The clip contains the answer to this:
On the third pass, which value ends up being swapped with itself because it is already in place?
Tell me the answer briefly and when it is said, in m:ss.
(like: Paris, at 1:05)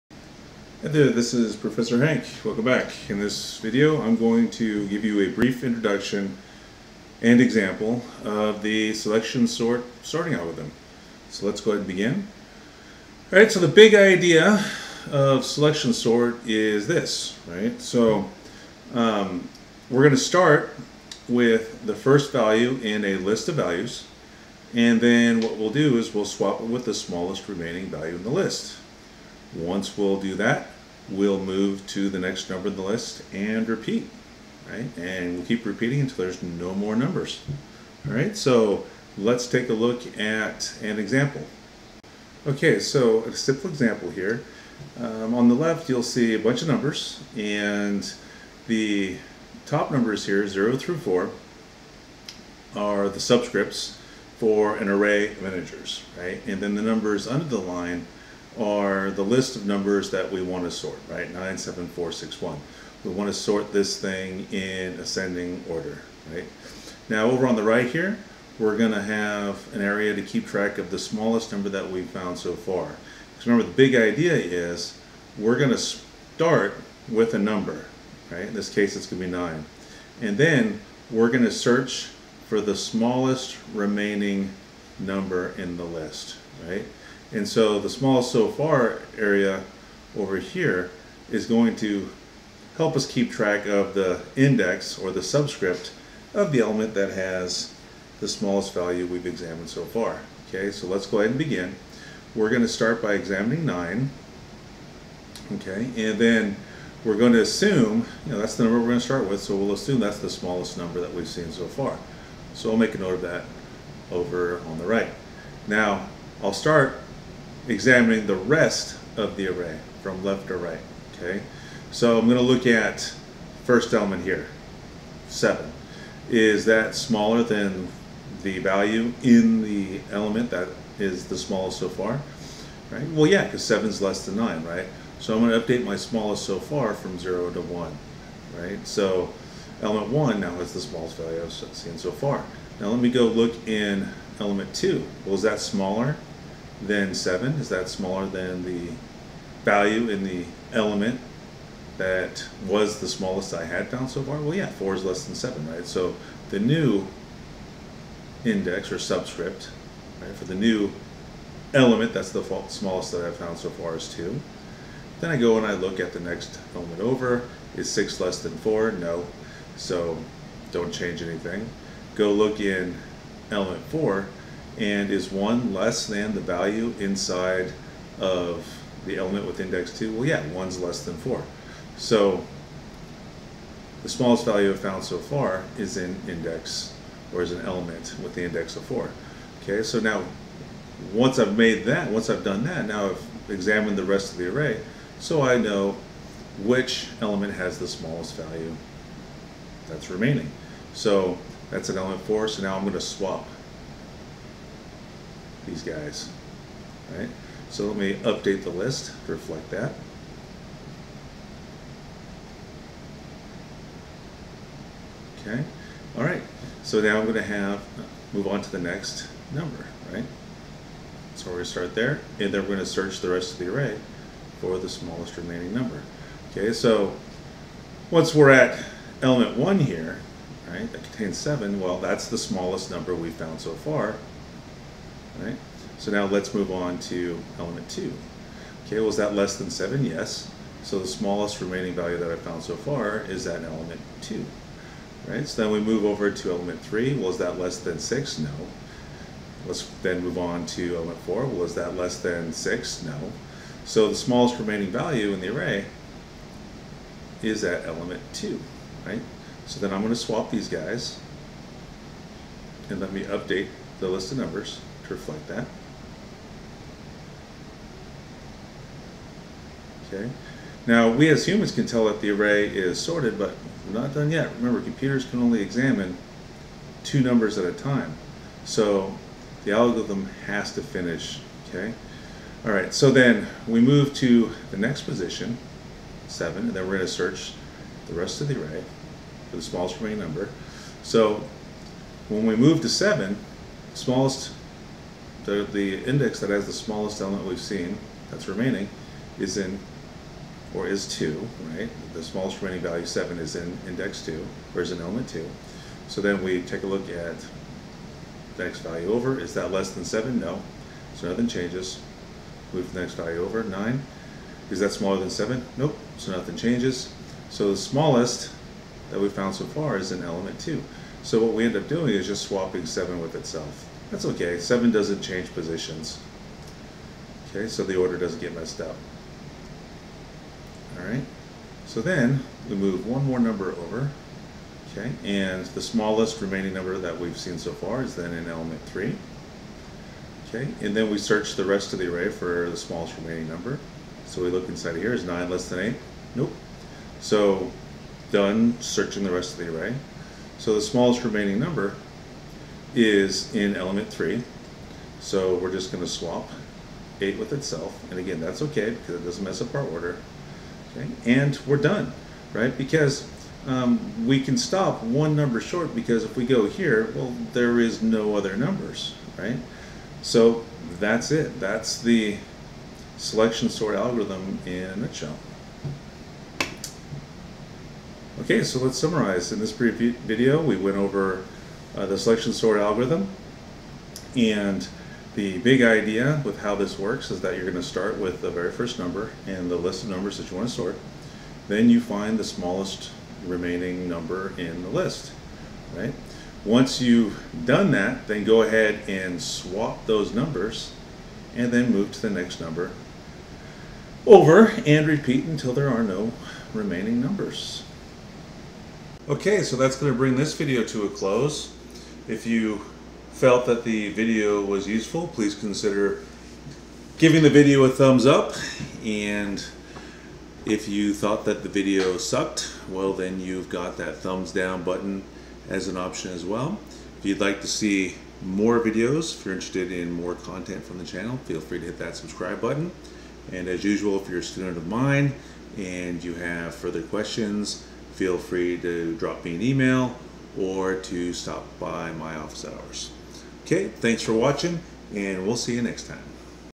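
7, at 5:22.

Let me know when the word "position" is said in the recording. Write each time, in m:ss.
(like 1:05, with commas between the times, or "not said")
4:45, 5:25.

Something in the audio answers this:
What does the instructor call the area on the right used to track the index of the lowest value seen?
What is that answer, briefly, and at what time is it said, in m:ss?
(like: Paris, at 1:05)
small so far, at 1:27.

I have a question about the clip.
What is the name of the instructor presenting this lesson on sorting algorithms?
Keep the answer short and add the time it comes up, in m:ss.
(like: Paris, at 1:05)
Professor Hank, at 0:01.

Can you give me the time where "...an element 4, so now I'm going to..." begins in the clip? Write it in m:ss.
3:21.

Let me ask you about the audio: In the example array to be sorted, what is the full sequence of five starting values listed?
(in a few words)
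9, 7, 4, 6, 1.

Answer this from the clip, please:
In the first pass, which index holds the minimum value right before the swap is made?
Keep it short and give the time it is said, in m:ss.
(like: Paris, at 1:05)
4, at 3:08.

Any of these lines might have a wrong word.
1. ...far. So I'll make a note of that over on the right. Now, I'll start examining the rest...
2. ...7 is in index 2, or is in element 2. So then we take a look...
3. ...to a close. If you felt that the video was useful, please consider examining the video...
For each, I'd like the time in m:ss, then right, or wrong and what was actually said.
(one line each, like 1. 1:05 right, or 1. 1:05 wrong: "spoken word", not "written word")
1. 1:51 right
2. 5:03 right
3. 6:50 wrong: "giving", not "examining".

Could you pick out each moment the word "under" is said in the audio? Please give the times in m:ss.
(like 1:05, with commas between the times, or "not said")
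0:57.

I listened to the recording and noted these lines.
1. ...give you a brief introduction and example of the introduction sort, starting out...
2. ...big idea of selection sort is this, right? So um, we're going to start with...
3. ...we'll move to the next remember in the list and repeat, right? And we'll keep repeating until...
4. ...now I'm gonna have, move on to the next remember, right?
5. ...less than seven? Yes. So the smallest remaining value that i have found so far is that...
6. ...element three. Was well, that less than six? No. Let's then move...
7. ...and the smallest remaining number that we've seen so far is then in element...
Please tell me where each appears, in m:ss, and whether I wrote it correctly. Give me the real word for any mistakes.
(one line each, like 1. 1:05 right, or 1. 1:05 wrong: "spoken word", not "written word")
1. 0:04 wrong: "selection", not "introduction"
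2. 0:13 right
3. 0:31 wrong: "number", not "remember"
4. 3:37 wrong: "number", not "remember"
5. 3:59 right
6. 4:06 right
7. 5:35 right.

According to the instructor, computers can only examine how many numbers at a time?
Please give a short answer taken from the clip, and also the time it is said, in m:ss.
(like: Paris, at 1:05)
2, at 4:37.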